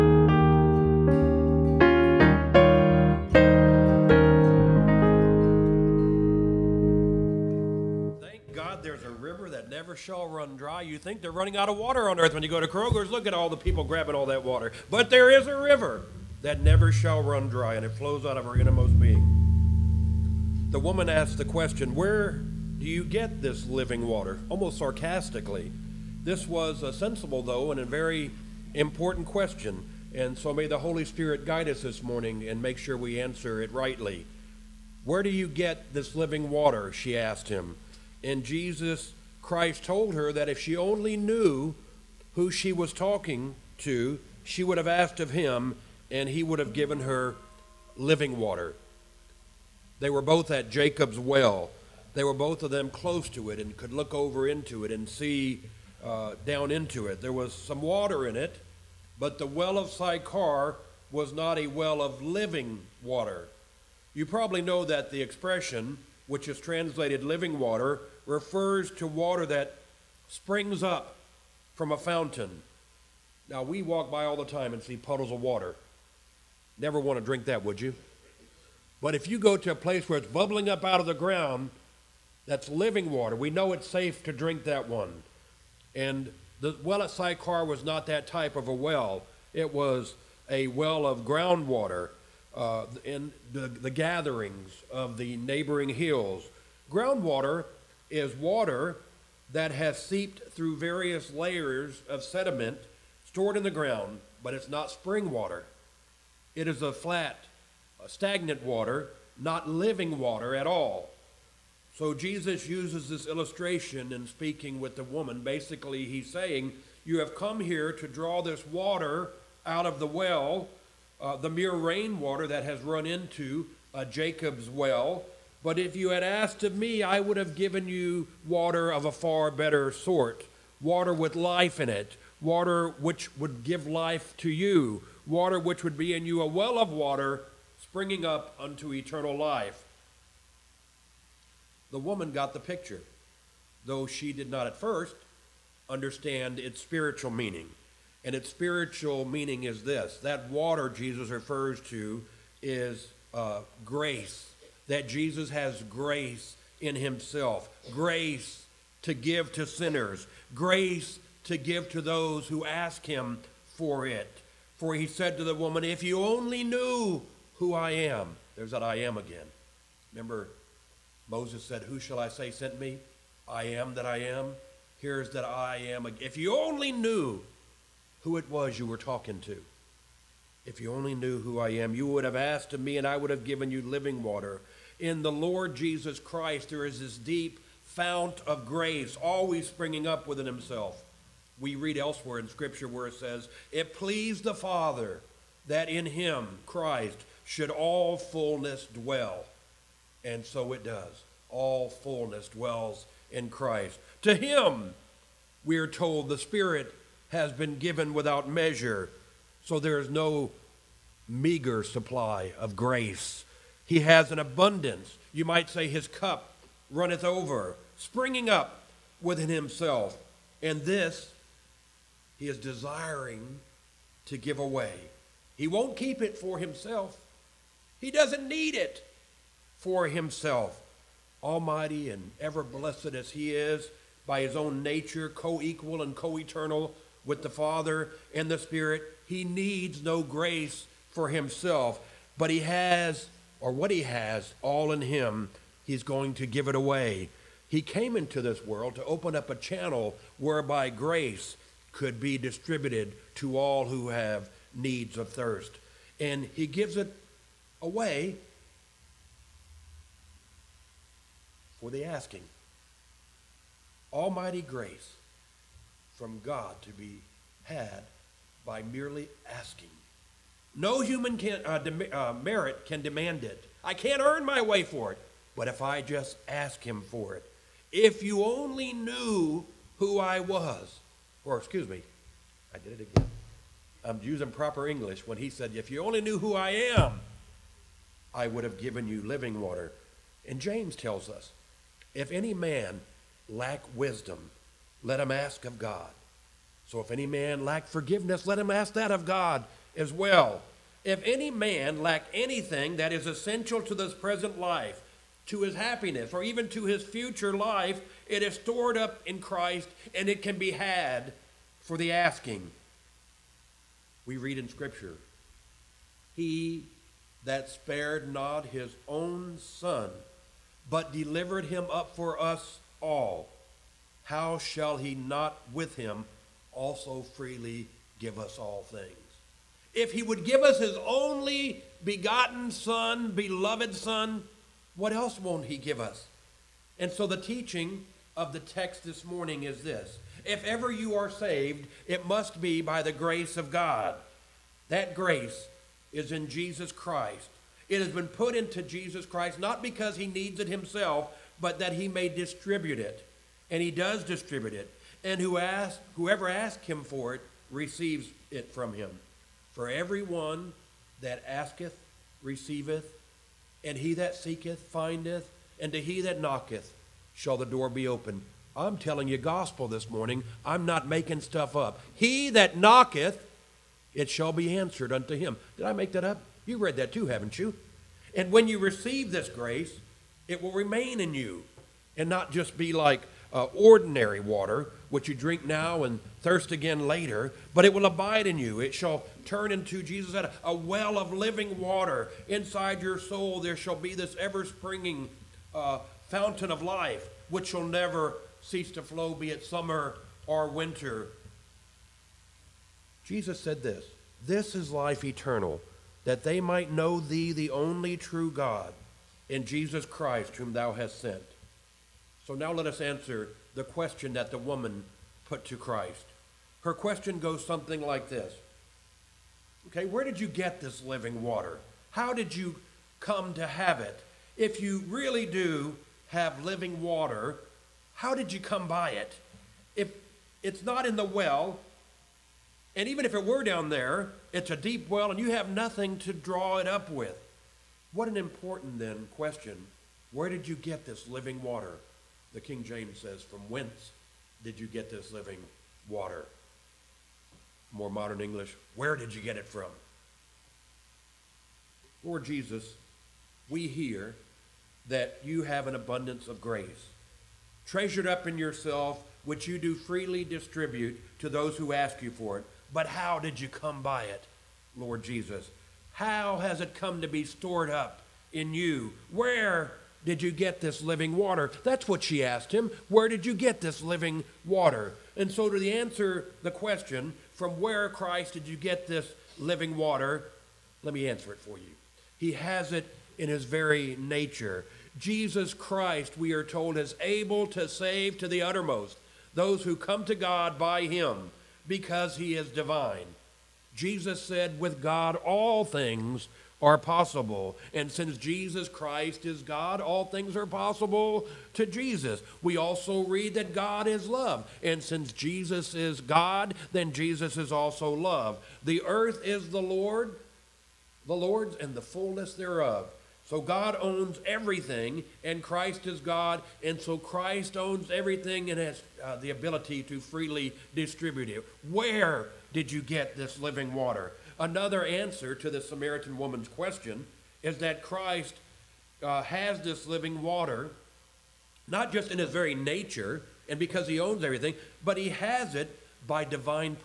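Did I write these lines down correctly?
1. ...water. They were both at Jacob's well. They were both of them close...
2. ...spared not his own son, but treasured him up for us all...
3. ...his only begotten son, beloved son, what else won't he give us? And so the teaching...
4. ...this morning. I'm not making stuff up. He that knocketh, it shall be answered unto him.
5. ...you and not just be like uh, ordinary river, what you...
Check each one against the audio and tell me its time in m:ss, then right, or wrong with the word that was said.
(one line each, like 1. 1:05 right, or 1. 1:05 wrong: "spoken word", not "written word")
1. 0:48 right
2. 5:17 wrong: "delivered", not "treasured"
3. 5:30 right
4. 6:09 right
5. 6:21 wrong: "water", not "river".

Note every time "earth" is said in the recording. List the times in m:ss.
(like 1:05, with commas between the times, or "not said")
0:12, 8:29.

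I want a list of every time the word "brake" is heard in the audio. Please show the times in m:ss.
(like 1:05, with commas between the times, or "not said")
not said.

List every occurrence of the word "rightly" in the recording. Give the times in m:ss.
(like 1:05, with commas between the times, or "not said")
0:33.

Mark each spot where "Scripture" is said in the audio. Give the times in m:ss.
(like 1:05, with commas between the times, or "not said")
3:12, 5:14.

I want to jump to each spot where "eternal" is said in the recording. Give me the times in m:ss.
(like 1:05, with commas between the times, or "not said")
2:18, 3:56, 6:45.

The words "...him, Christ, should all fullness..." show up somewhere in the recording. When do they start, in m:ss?
3:16.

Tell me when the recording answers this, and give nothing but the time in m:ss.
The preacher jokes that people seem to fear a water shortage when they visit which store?
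0:12.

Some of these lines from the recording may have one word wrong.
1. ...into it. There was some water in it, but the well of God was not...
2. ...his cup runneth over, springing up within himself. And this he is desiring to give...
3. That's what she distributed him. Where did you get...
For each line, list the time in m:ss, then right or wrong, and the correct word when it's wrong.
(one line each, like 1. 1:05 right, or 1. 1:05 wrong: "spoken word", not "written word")
1. 0:56 wrong: "Sychar", not "God"
2. 3:35 right
3. 7:51 wrong: "asked", not "distributed".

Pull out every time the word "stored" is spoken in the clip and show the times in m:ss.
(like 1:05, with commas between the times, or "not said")
1:43, 5:08, 7:47.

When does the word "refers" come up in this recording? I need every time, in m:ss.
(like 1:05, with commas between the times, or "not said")
1:08, 2:31.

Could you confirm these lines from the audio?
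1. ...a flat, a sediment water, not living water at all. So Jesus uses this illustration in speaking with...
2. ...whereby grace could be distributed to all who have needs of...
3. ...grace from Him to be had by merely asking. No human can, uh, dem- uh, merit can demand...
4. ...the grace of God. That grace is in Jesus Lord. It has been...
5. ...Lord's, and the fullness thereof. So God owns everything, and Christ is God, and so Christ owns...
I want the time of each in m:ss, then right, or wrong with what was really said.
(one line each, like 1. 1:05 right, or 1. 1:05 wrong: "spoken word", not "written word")
1. 1:46 wrong: "stagnant", not "sediment"
2. 4:10 right
3. 4:24 wrong: "God", not "Him"
4. 5:43 wrong: "Christ", not "Lord"
5. 8:31 right.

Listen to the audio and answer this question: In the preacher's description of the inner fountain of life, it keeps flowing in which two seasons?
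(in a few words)
Summer or winter.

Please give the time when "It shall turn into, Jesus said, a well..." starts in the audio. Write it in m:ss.
6:28.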